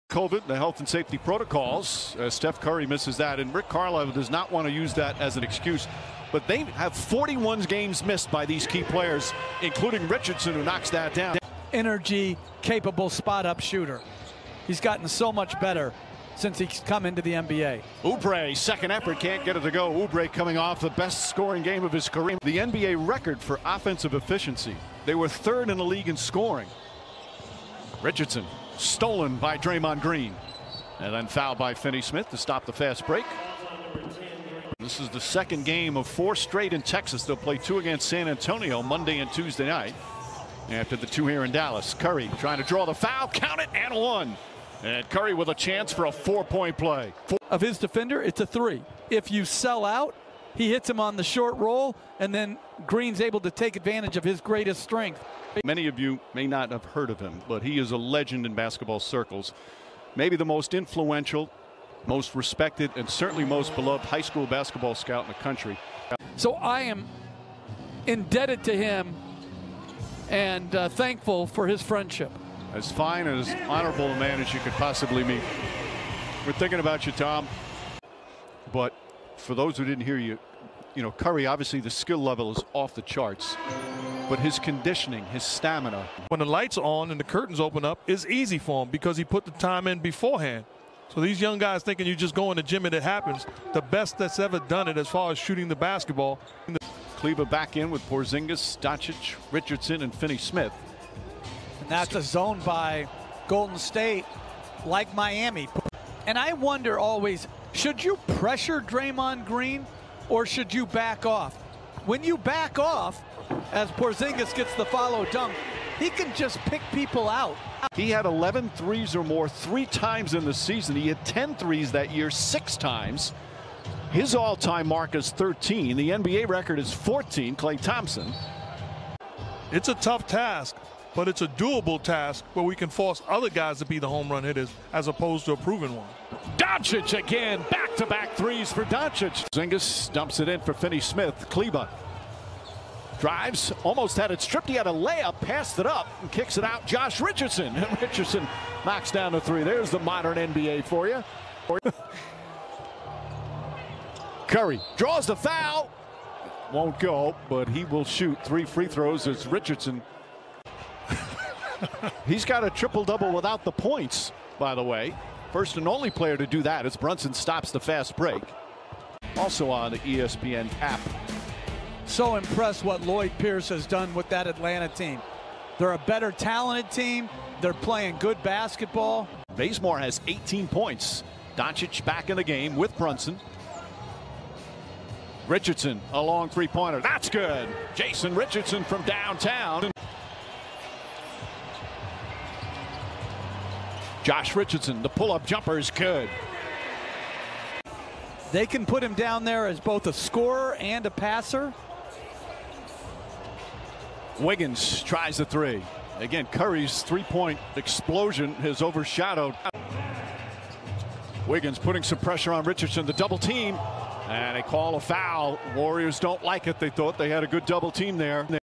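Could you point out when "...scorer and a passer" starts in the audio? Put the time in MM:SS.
03:20.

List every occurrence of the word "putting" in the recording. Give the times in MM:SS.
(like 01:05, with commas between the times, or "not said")
03:31.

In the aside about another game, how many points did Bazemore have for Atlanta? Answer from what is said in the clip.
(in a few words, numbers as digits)
18.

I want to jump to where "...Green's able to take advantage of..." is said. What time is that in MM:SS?
00:52.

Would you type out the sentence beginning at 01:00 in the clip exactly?
Maybe the most influential, most respected, and certainly most beloved high school basketball scout in the country.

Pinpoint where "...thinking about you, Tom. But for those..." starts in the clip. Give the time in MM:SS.
01:16.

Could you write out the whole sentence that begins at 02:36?
Won't go, but he will shoot three free throws as Richardson He's got a triple double without the points, by the way.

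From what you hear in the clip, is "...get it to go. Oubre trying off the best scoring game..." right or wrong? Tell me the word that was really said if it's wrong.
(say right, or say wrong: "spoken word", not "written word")
wrong: "coming", not "trying".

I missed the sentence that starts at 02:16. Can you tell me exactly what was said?
Doncic again, back-to-back -back to back 3s for Doncic.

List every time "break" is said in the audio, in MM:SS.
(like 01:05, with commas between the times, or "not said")
00:33, 02:48.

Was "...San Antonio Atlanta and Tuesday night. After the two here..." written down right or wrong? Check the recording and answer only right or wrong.
wrong.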